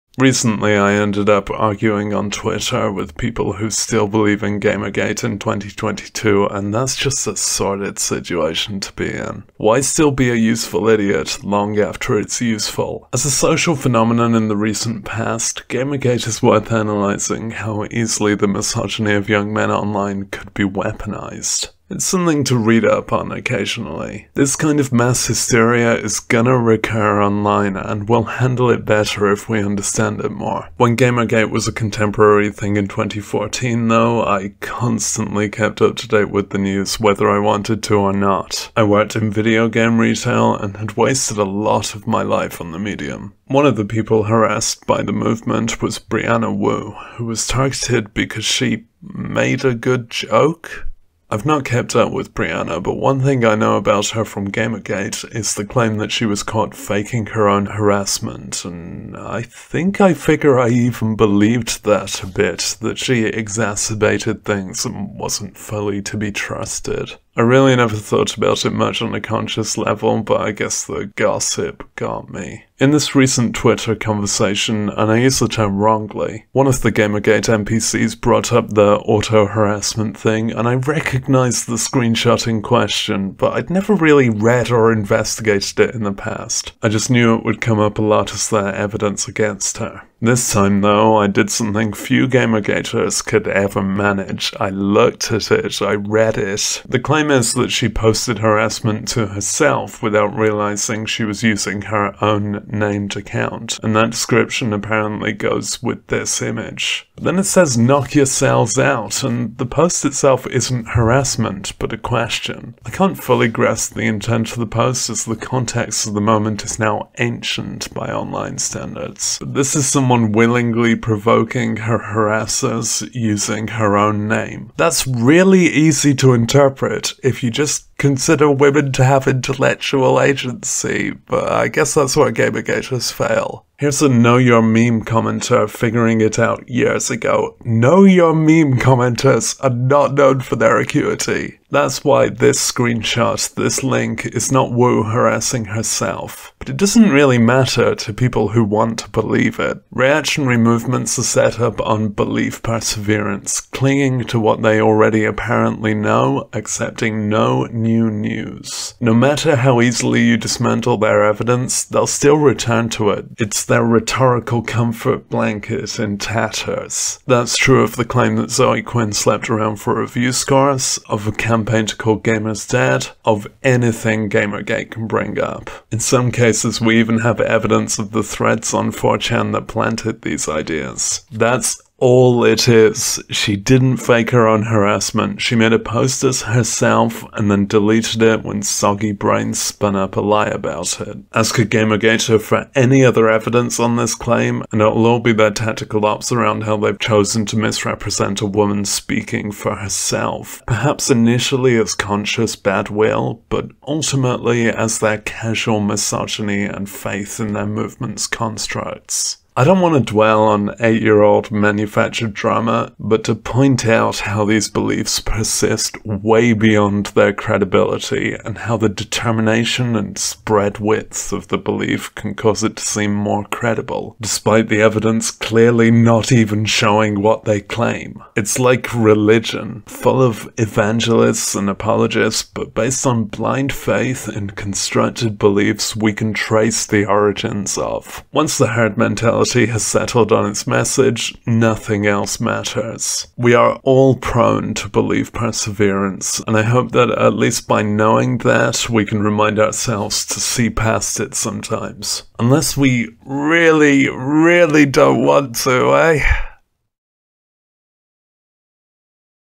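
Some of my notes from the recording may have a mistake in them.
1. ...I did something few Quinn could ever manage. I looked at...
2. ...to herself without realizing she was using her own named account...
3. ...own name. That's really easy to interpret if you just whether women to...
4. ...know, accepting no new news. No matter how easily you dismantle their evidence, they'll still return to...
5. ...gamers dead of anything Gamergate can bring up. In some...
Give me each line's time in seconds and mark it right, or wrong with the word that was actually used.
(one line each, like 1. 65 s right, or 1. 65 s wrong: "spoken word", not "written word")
1. 91 s wrong: "Gamergaters", not "Quinn"
2. 99 s right
3. 123 s wrong: "consider", not "whether"
4. 155 s right
5. 172 s right.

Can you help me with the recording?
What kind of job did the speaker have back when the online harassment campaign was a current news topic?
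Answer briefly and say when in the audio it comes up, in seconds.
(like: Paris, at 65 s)
video game retail, at 39 s.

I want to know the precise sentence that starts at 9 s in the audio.
Why still be a useful idiot long after it's useful?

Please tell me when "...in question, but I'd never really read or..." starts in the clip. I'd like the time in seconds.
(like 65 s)
82 s.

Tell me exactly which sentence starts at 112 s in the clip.
I can't fully grasp the intent of the post as the context of the moment is now ancient by online standards.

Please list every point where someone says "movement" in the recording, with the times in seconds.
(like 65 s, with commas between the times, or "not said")
45 s, 150 s, 207 s.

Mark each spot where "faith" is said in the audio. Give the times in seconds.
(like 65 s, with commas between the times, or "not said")
206 s, 233 s.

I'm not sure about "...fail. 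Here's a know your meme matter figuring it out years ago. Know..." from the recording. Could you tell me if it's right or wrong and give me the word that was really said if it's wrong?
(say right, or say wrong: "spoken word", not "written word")
wrong: "commenter", not "matter".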